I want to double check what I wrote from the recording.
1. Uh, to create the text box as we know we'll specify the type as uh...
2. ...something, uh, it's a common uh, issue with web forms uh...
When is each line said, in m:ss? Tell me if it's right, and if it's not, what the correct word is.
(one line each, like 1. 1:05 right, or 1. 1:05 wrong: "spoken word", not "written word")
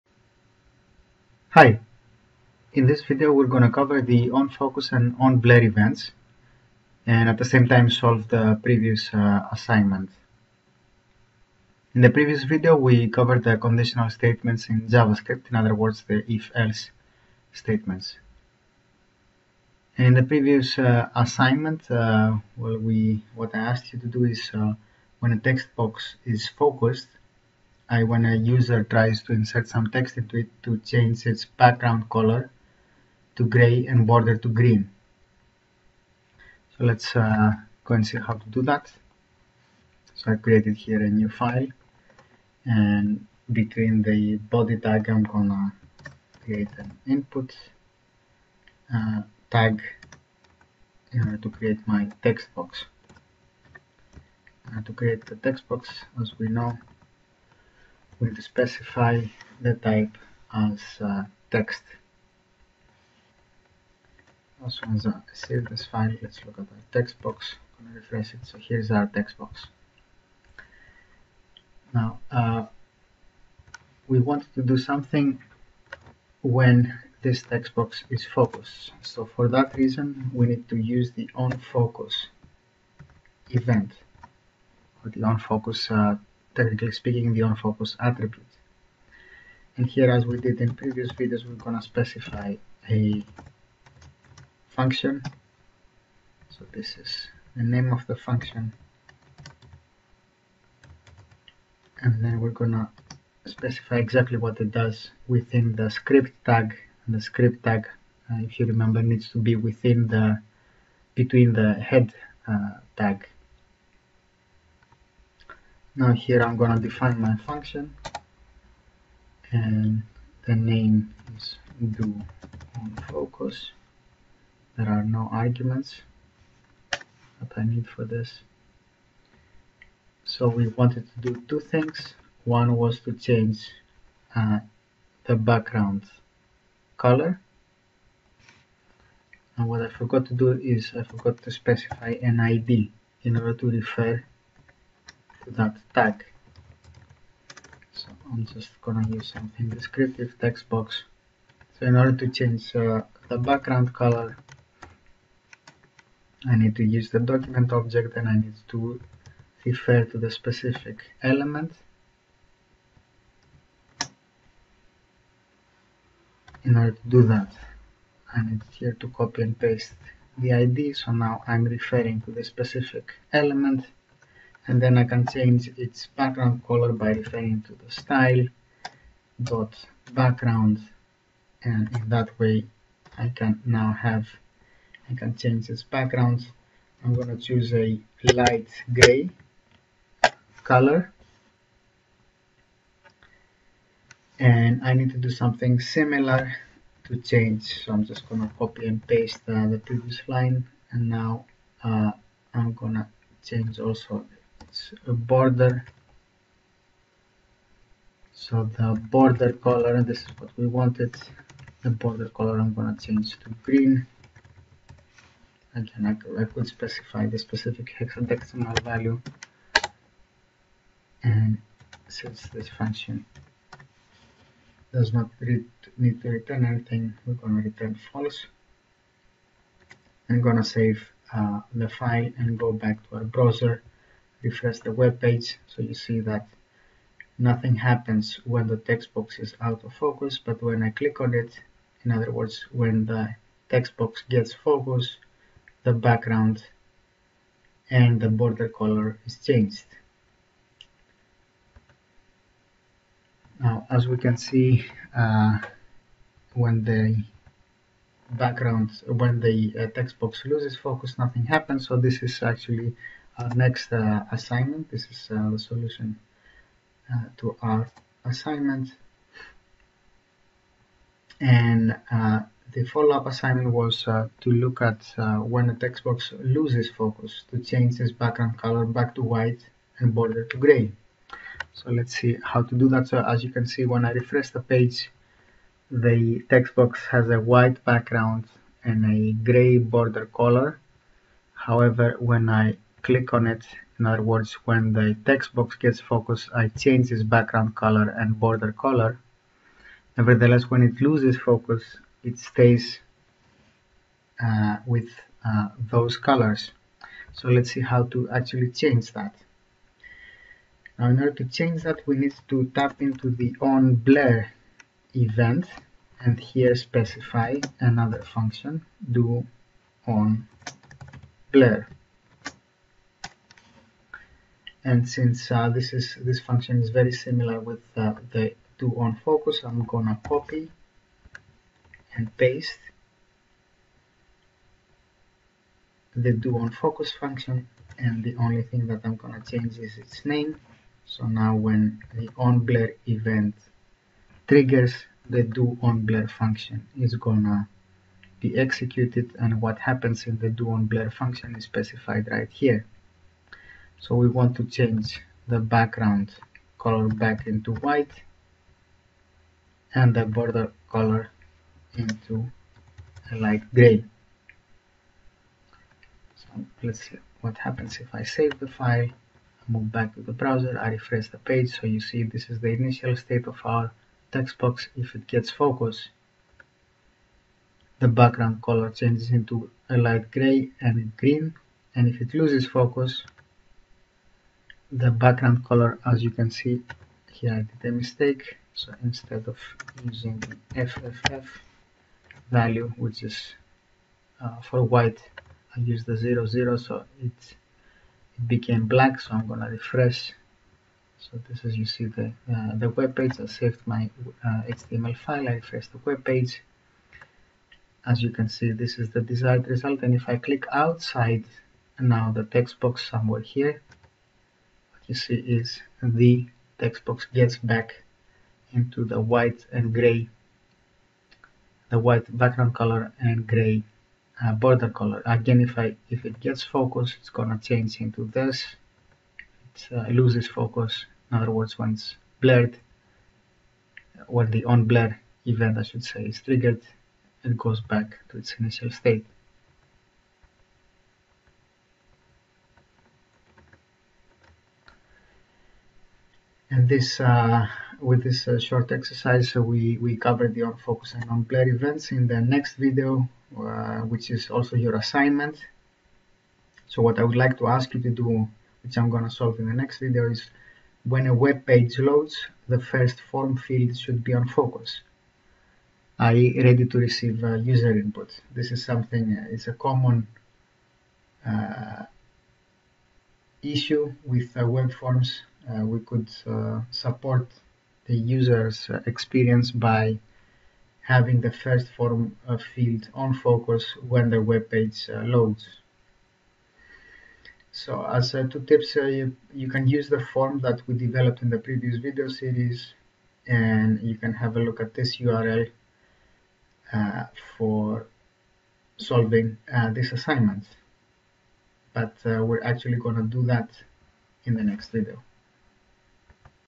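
1. 0:54 right
2. 7:48 right.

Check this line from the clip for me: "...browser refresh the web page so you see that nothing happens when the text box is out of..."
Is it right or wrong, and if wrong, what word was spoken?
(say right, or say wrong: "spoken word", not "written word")
right.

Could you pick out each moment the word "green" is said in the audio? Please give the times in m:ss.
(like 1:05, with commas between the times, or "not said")
0:34, 3:33, 6:21.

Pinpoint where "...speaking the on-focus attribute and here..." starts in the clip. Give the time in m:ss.
1:26.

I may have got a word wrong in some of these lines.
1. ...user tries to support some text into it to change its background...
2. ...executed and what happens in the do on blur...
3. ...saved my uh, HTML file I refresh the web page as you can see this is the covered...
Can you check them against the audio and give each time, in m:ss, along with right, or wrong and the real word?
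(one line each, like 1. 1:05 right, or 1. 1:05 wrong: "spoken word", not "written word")
1. 0:28 wrong: "insert", not "support"
2. 5:48 right
3. 6:43 wrong: "desired", not "covered".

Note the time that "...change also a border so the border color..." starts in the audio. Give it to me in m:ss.
3:23.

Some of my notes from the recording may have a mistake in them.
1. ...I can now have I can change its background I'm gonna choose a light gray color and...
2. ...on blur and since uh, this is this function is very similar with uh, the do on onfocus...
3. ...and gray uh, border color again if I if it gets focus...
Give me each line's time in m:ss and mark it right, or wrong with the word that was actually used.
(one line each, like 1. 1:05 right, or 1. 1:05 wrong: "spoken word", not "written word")
1. 3:03 right
2. 5:20 wrong: "focus", not "onfocus"
3. 7:03 right.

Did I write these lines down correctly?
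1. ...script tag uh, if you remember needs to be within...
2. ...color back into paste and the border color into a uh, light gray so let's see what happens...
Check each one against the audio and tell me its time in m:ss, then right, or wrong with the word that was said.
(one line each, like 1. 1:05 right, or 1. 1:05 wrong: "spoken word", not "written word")
1. 1:47 right
2. 5:56 wrong: "white", not "paste".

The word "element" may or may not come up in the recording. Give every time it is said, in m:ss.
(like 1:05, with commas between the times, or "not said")
2:41, 2:53.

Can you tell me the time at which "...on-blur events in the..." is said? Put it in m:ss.
7:31.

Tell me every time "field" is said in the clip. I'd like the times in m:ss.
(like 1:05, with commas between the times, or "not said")
7:43, 8:02.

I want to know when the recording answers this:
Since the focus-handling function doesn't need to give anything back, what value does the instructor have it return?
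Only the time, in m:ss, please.
3:47.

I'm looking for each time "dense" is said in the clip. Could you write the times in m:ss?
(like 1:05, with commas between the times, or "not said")
not said.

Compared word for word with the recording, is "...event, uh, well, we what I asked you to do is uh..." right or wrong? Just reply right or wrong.
wrong.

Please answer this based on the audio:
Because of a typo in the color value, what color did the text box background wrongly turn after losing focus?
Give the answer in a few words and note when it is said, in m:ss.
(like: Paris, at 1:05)
black, at 6:38.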